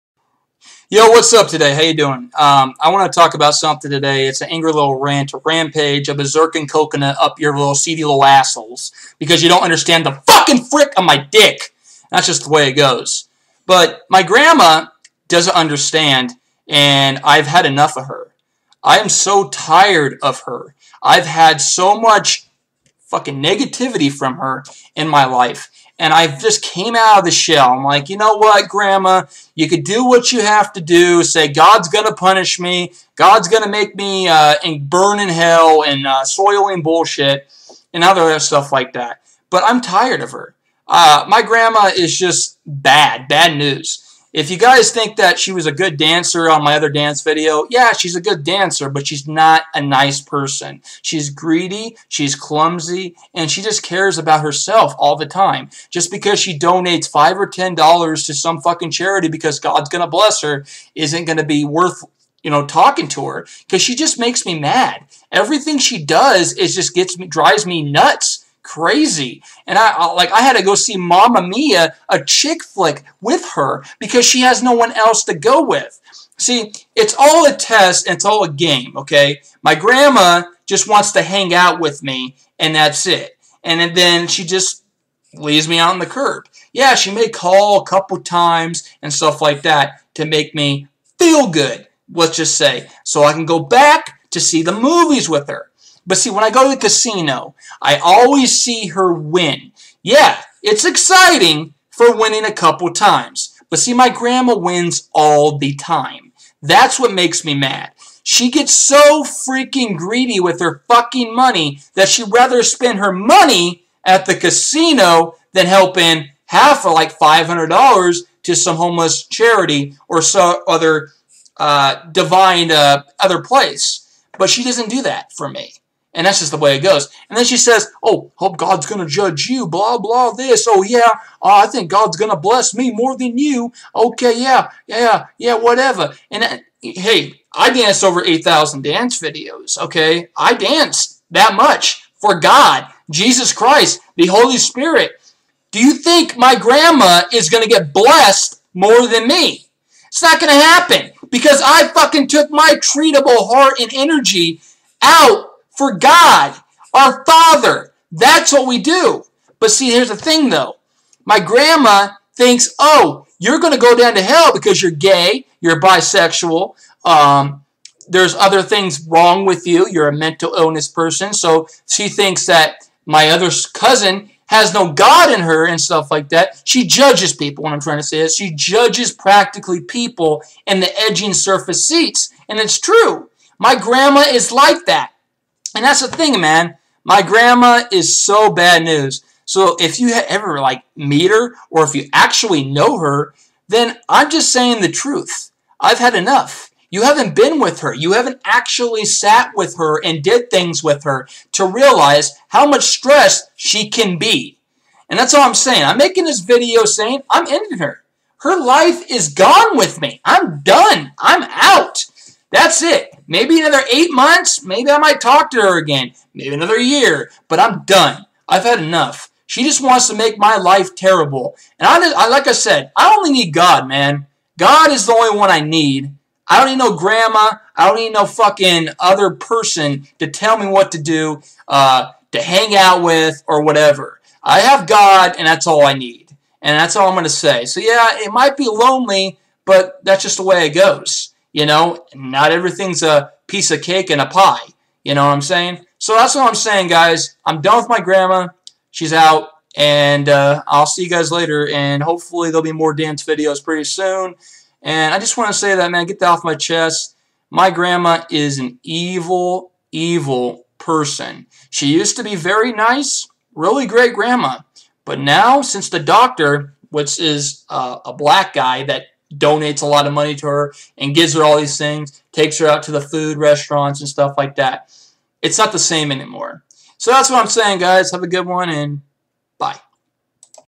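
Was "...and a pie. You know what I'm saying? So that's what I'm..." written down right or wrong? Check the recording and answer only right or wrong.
right.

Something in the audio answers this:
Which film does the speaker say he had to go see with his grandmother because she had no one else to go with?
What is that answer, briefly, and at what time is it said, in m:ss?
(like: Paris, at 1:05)
Mamma Mia, at 1:10.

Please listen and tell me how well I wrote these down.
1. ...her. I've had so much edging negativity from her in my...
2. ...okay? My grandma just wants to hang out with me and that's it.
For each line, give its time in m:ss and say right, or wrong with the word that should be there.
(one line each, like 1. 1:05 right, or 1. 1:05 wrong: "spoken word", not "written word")
1. 0:20 wrong: "fucking", not "edging"
2. 1:18 right.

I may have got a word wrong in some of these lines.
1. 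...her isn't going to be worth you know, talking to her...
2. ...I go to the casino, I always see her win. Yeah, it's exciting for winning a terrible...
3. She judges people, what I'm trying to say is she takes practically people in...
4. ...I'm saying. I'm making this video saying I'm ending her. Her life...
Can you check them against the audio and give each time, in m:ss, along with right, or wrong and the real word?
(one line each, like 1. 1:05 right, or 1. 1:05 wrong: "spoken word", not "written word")
1. 1:00 right
2. 1:36 wrong: "couple", not "terrible"
3. 2:56 wrong: "judges", not "takes"
4. 3:25 right.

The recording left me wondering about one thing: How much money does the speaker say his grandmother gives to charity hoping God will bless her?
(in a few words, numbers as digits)
5 or $10.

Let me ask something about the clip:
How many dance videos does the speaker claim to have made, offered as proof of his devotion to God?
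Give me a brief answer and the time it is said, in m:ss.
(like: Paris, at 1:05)
8,000, at 2:18.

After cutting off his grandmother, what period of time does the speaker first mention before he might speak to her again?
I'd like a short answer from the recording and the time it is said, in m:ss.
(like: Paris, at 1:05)
8 months, at 3:33.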